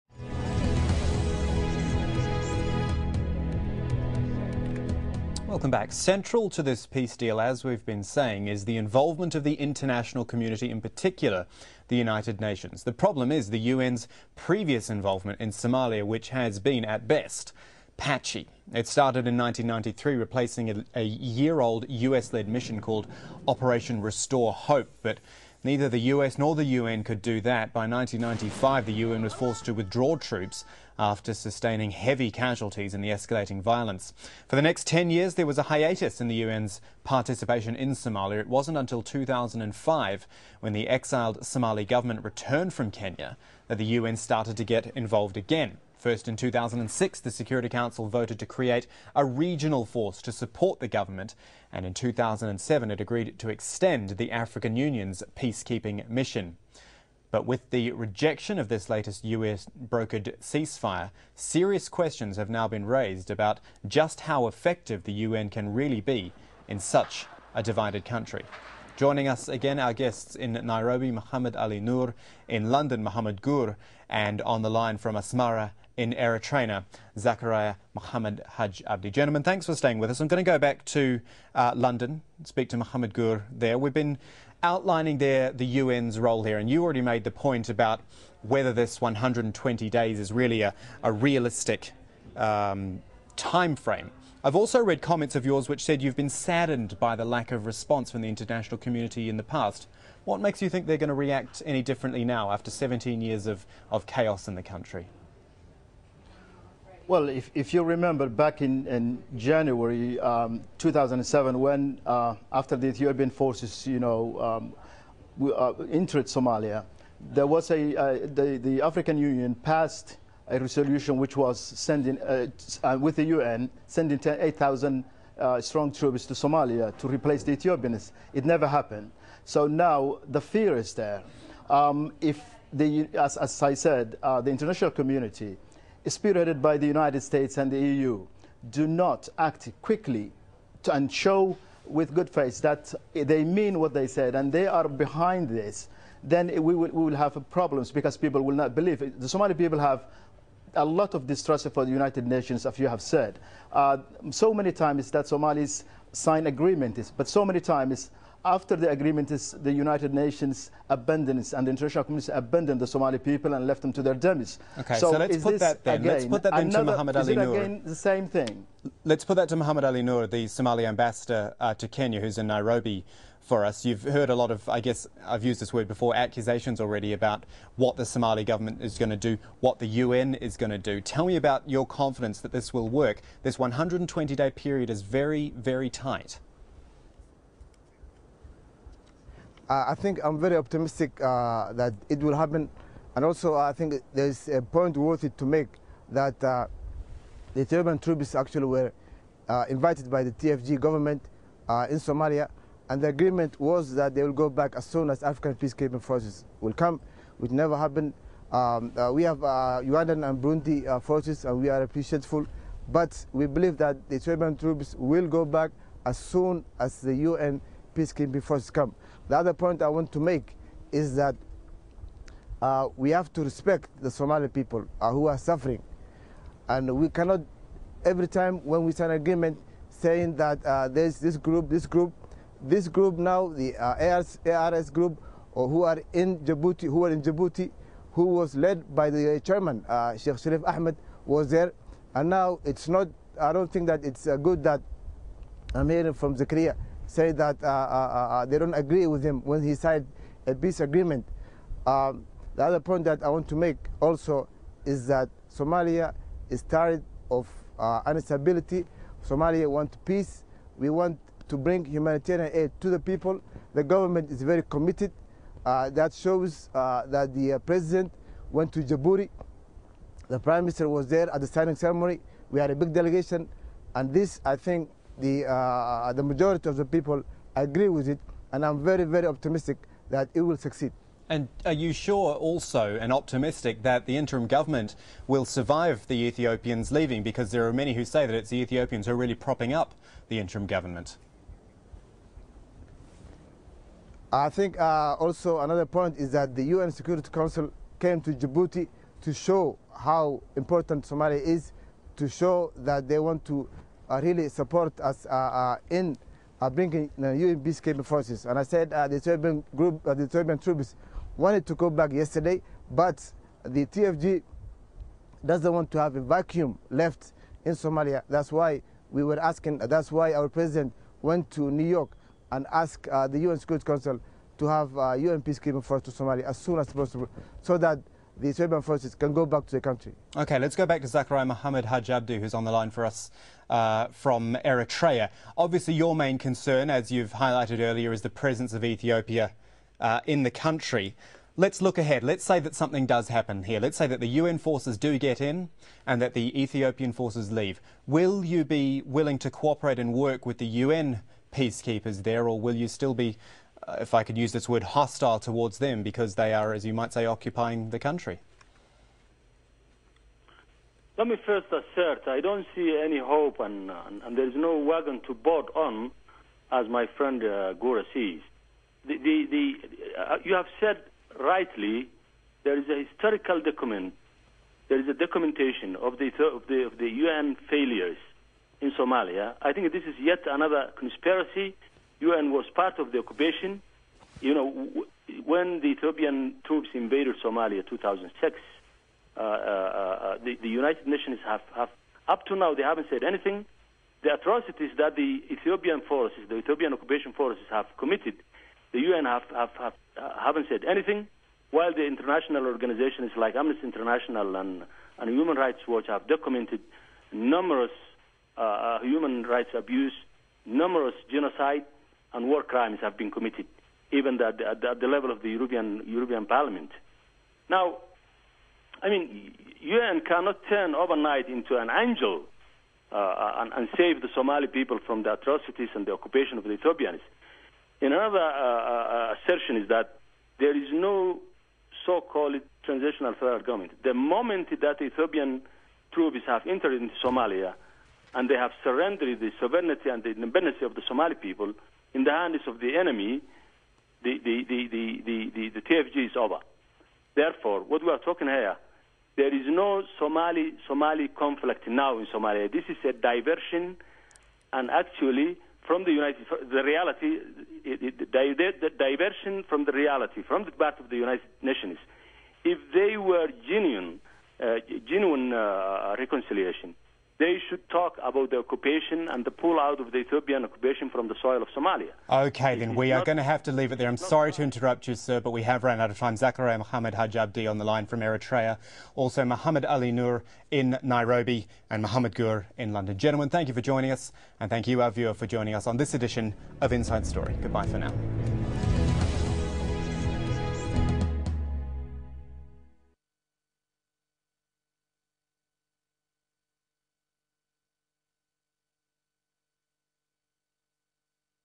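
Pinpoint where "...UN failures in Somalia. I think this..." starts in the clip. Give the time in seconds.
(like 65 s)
377 s.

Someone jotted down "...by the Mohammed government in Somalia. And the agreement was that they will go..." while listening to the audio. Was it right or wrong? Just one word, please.
wrong.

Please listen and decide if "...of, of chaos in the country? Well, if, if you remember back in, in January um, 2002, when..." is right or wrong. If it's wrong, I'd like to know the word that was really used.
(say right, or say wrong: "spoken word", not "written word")
wrong: "2007", not "2002".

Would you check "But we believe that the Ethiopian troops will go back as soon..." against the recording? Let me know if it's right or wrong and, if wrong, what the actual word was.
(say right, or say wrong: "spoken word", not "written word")
right.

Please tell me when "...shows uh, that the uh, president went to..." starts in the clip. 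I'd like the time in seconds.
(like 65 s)
266 s.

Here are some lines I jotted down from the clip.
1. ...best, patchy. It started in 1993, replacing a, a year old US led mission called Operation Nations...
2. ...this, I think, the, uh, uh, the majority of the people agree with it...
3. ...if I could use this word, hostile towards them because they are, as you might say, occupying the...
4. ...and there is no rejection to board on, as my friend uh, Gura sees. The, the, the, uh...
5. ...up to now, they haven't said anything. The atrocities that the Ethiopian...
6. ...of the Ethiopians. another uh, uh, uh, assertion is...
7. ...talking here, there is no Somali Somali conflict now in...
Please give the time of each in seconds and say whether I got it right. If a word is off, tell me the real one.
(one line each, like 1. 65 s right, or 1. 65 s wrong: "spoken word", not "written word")
1. 17 s wrong: "Restore", not "Nations"
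2. 274 s right
3. 353 s right
4. 364 s wrong: "wagon", not "rejection"
5. 392 s right
6. 426 s right
7. 448 s right.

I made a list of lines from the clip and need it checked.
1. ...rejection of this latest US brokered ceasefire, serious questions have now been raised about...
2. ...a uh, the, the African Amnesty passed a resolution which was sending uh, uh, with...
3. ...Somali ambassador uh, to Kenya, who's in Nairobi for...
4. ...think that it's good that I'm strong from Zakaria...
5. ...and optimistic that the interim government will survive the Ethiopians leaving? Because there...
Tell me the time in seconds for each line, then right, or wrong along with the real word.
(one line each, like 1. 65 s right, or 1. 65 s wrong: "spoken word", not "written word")
1. 57 s right
2. 117 s wrong: "Union", not "Amnesty"
3. 170 s right
4. 243 s wrong: "hearing", not "strong"
5. 282 s right.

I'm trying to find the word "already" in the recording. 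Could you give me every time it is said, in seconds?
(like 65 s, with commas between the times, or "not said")
86 s, 176 s.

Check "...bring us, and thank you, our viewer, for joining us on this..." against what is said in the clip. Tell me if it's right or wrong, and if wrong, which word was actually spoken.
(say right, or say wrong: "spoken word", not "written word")
wrong: "joining", not "bring".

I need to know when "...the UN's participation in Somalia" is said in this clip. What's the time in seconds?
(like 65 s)
36 s.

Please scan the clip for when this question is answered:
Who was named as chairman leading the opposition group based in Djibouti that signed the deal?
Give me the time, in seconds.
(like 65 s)
240 s.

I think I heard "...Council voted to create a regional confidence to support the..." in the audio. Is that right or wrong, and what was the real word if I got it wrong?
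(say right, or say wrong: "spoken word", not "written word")
wrong: "force", not "confidence".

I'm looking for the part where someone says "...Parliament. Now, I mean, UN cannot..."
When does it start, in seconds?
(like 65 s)
416 s.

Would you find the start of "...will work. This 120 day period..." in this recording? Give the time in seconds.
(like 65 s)
182 s.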